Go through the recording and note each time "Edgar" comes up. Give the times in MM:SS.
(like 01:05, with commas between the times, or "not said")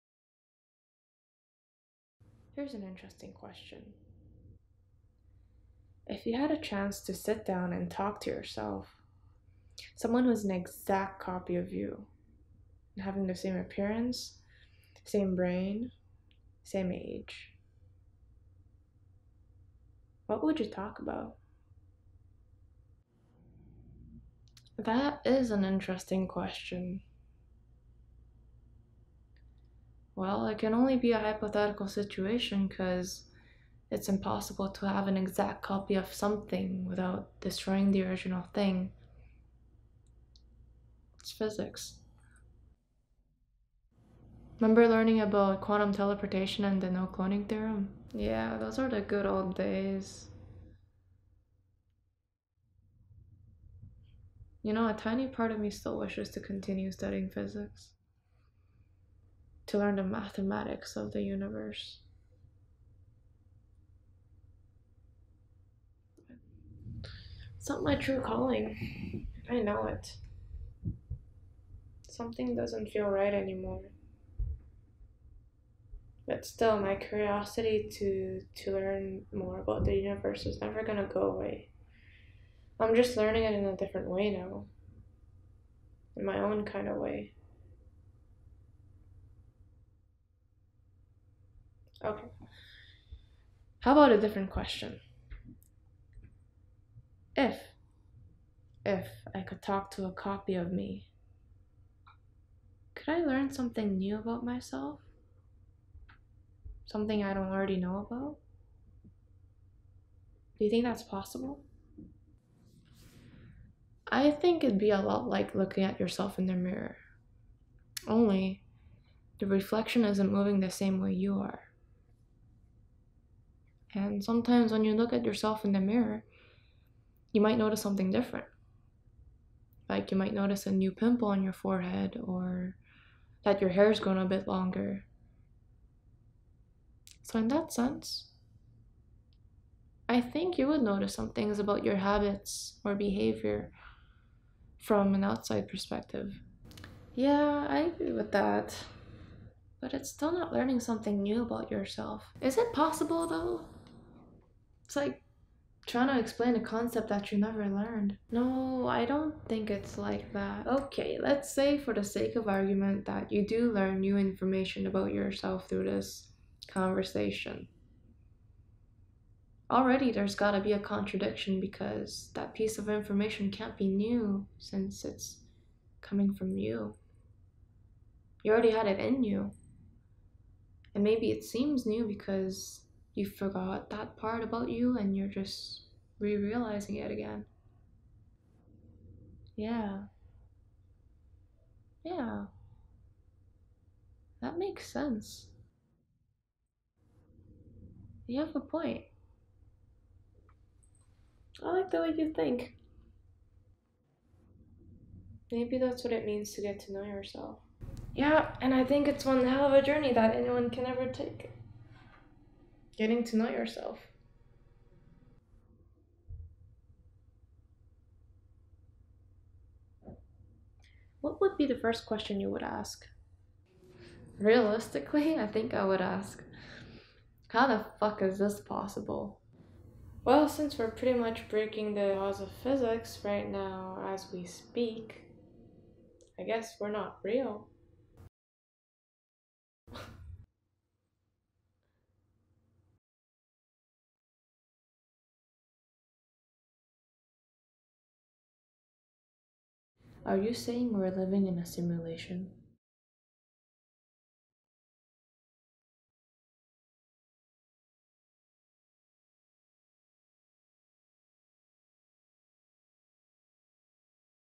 not said.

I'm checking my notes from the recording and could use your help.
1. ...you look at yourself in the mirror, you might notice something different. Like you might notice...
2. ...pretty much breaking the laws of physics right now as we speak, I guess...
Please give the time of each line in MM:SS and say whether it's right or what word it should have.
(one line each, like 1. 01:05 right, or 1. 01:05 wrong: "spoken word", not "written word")
1. 02:04 right
2. 03:50 right.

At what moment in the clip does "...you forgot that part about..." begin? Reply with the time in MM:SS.
03:03.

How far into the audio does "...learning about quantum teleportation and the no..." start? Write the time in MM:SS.
00:44.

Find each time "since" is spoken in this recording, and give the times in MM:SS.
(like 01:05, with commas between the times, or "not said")
02:54, 03:50.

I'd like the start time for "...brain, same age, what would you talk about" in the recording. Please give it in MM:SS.
00:15.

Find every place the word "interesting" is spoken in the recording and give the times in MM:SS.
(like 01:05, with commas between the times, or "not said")
00:02, 00:25.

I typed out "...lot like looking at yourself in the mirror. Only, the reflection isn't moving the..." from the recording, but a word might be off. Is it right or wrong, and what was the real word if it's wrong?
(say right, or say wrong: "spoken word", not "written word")
right.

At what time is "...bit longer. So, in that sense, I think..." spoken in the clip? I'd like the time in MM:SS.
02:14.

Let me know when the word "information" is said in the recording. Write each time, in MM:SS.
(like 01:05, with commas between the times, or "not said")
02:44, 02:52.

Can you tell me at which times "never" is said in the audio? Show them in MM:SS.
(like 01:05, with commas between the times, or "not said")
01:20, 02:37.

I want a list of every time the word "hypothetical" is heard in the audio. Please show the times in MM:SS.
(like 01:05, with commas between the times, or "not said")
00:31.